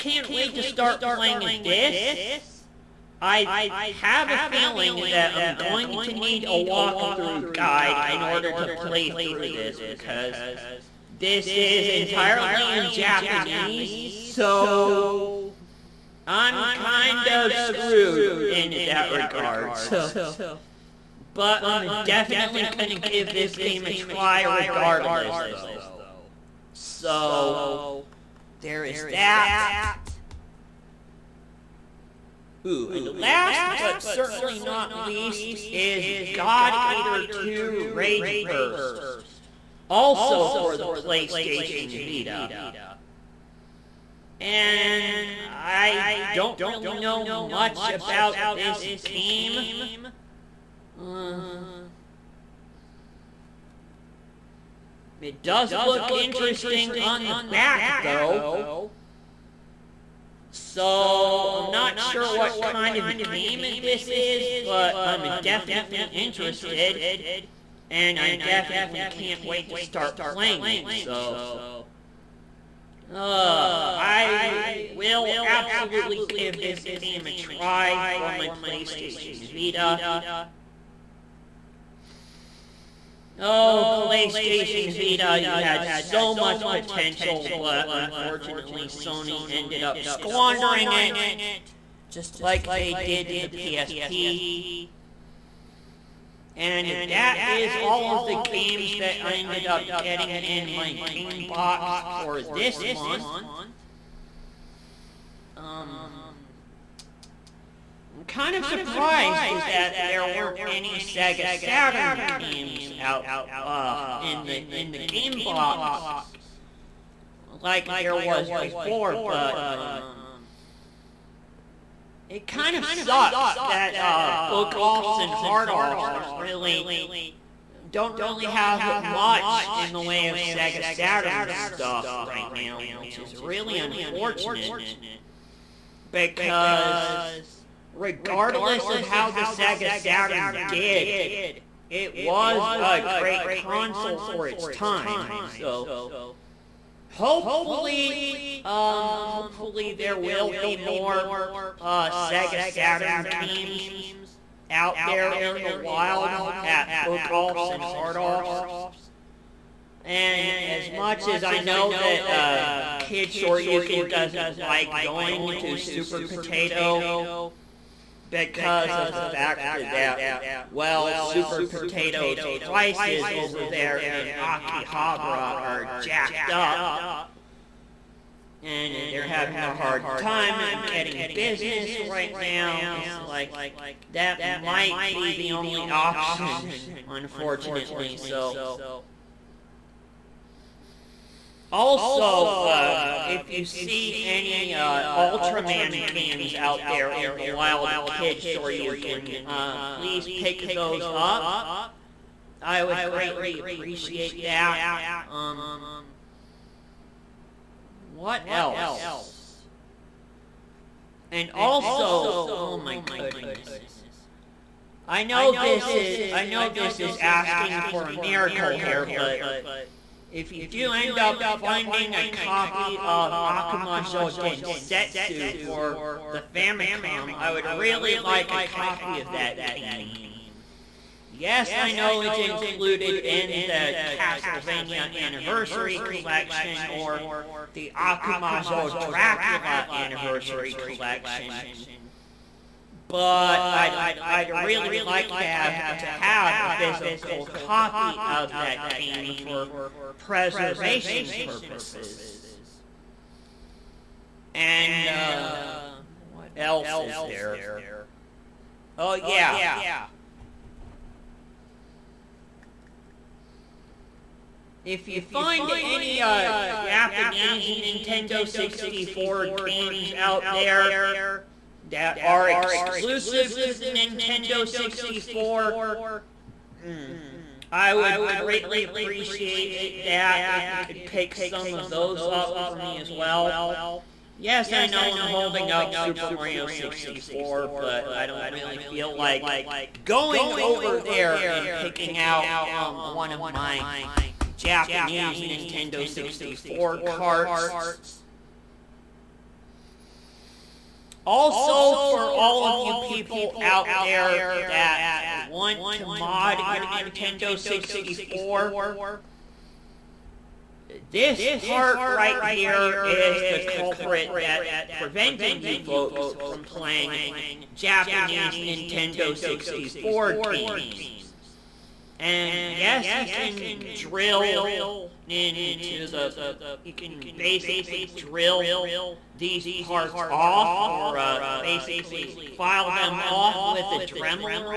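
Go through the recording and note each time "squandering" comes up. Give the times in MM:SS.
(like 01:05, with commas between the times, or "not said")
01:30.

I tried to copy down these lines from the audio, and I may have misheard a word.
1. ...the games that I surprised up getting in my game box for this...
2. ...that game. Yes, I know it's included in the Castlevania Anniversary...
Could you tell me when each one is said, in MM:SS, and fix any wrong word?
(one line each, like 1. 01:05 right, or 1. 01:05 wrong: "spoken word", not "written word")
1. 01:38 wrong: "ended", not "surprised"
2. 03:49 right.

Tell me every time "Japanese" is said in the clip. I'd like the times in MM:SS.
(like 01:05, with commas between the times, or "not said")
00:12, 04:26, 04:54, 05:17.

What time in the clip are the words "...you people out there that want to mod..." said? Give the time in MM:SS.
05:02.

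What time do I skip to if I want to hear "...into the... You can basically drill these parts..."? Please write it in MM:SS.
05:25.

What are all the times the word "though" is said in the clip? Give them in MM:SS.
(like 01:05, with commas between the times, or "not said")
00:25, 00:58.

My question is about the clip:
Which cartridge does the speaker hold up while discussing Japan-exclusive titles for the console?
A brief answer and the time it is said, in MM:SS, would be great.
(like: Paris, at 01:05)
Super Mario 64, at 04:45.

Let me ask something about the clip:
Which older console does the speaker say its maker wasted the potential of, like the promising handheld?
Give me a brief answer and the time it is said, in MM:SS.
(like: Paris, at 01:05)
PSP, at 01:33.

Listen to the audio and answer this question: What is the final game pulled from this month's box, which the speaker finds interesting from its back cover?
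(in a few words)
God Eater 2 Rage Burst.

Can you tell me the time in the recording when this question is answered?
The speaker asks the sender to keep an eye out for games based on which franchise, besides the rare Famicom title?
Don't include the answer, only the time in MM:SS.
03:15.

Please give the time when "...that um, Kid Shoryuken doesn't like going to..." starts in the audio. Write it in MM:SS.
02:41.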